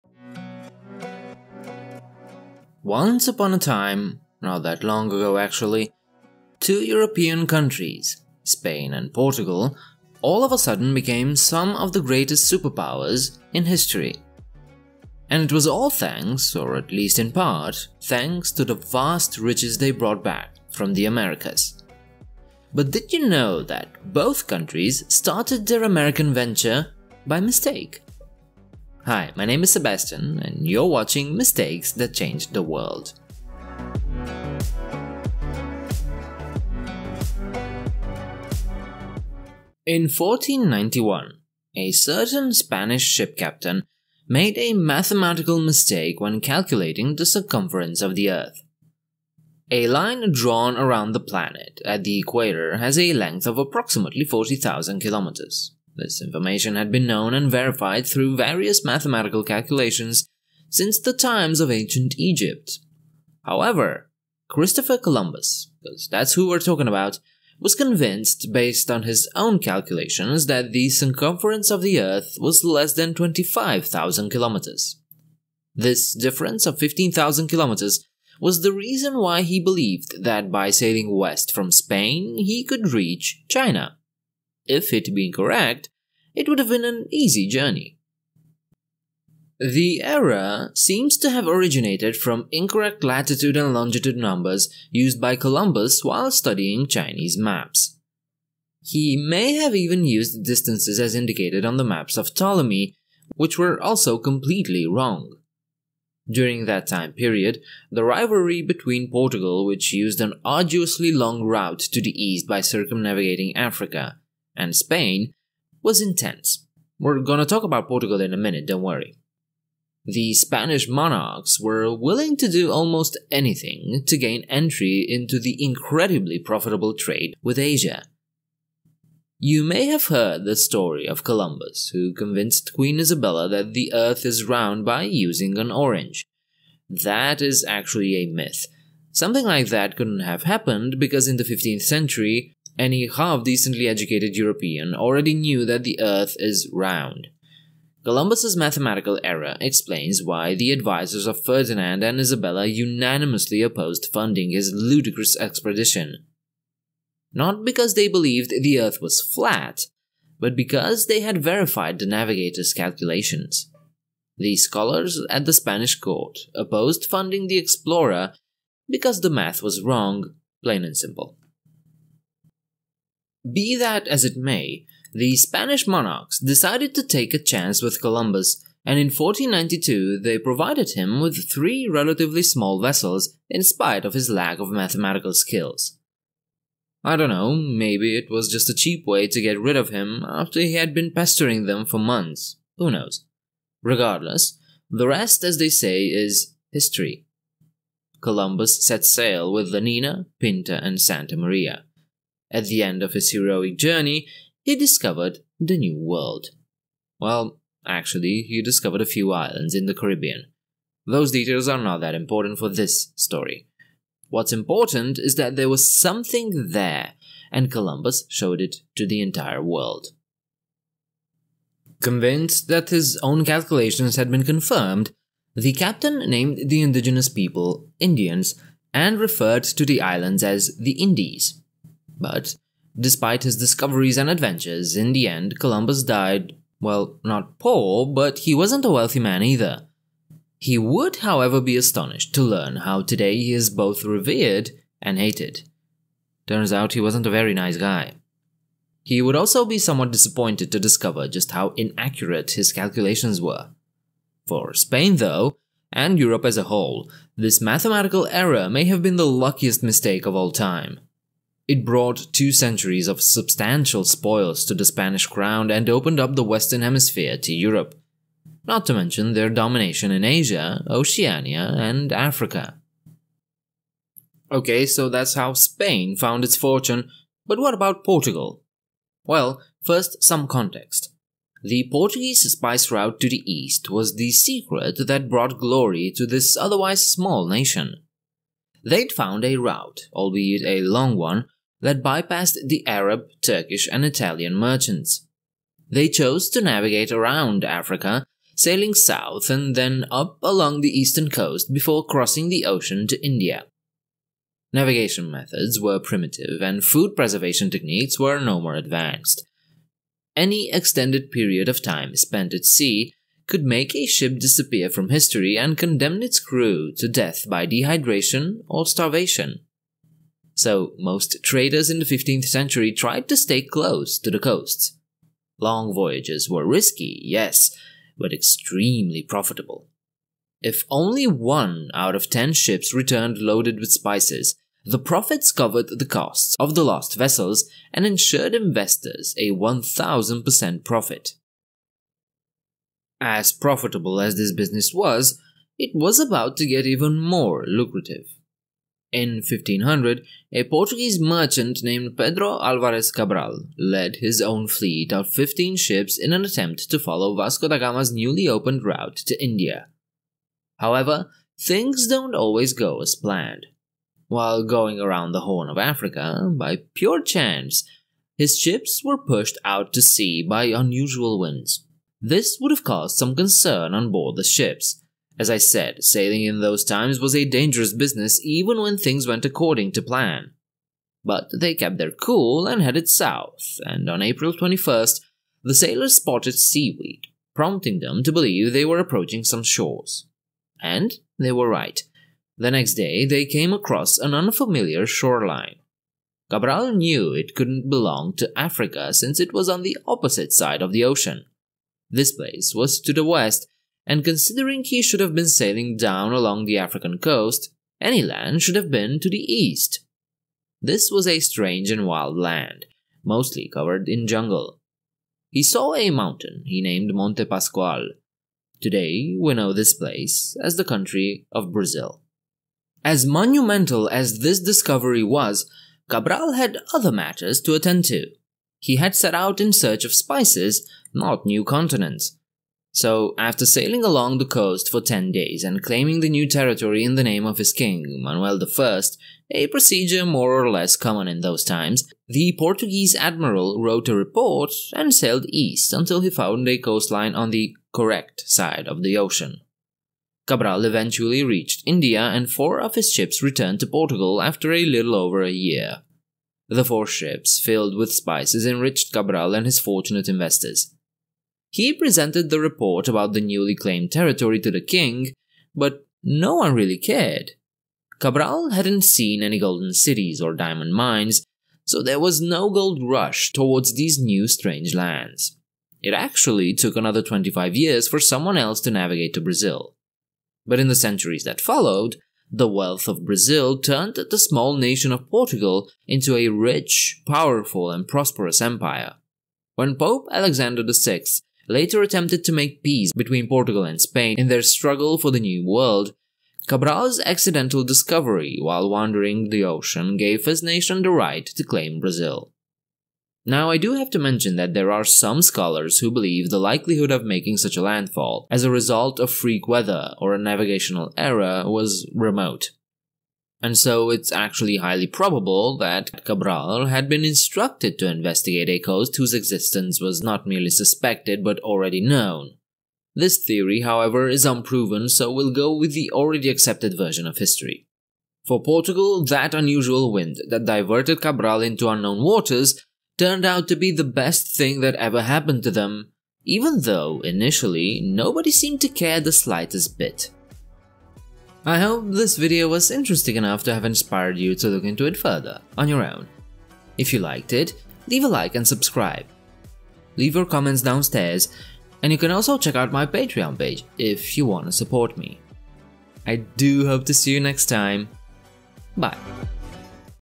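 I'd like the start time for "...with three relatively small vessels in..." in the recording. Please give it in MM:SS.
03:01.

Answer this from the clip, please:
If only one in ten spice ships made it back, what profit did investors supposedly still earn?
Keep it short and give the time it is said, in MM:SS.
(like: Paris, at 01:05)
1000%, at 05:39.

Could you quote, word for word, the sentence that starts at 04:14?
For Spain, though, and Europe as a whole, this mathematical error may have been the luckiest mistake of all time.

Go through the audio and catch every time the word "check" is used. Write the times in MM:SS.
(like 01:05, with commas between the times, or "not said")
09:12.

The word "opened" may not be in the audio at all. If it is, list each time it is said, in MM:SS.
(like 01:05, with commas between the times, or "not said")
04:25, 05:58.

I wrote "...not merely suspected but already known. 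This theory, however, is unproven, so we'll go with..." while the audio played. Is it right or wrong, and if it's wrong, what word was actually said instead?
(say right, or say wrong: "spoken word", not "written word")
right.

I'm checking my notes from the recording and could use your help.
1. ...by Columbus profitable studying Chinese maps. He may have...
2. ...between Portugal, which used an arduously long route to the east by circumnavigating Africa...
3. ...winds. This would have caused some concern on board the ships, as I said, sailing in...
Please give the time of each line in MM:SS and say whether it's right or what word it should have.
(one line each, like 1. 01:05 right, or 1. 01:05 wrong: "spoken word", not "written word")
1. 01:35 wrong: "while", not "profitable"
2. 01:48 right
3. 06:11 right.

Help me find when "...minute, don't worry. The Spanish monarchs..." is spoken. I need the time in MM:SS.
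01:58.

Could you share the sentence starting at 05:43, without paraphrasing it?
As profitable as this business was, it was about to get even more lucrative.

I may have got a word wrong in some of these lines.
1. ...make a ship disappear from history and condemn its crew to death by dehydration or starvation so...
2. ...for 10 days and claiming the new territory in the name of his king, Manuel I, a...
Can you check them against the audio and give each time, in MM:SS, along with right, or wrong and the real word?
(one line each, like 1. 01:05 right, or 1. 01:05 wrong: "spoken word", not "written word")
1. 05:13 right
2. 07:14 right.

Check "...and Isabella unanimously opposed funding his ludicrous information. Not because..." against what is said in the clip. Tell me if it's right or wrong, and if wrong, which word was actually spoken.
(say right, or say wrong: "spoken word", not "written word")
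wrong: "expedition", not "information".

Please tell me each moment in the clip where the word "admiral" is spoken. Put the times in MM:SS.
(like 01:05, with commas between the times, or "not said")
07:23.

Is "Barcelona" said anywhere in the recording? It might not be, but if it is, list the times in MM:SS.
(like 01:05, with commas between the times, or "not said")
not said.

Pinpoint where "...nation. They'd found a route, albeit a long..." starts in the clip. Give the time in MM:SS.
04:47.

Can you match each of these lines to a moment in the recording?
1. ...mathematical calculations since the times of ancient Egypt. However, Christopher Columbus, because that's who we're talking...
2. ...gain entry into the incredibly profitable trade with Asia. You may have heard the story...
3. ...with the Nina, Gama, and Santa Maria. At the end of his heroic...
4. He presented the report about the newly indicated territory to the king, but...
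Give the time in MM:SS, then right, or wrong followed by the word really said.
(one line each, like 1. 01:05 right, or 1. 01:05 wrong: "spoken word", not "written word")
1. 00:58 right
2. 02:04 right
3. 03:19 wrong: "Pinta", not "Gama"
4. 07:41 wrong: "claimed", not "indicated".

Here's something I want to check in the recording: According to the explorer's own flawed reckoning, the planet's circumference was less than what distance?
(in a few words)
25,000 kilometers.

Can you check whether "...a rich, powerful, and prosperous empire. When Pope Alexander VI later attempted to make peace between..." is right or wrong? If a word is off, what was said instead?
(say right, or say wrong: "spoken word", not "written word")
right.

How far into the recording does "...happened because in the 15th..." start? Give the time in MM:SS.
02:20.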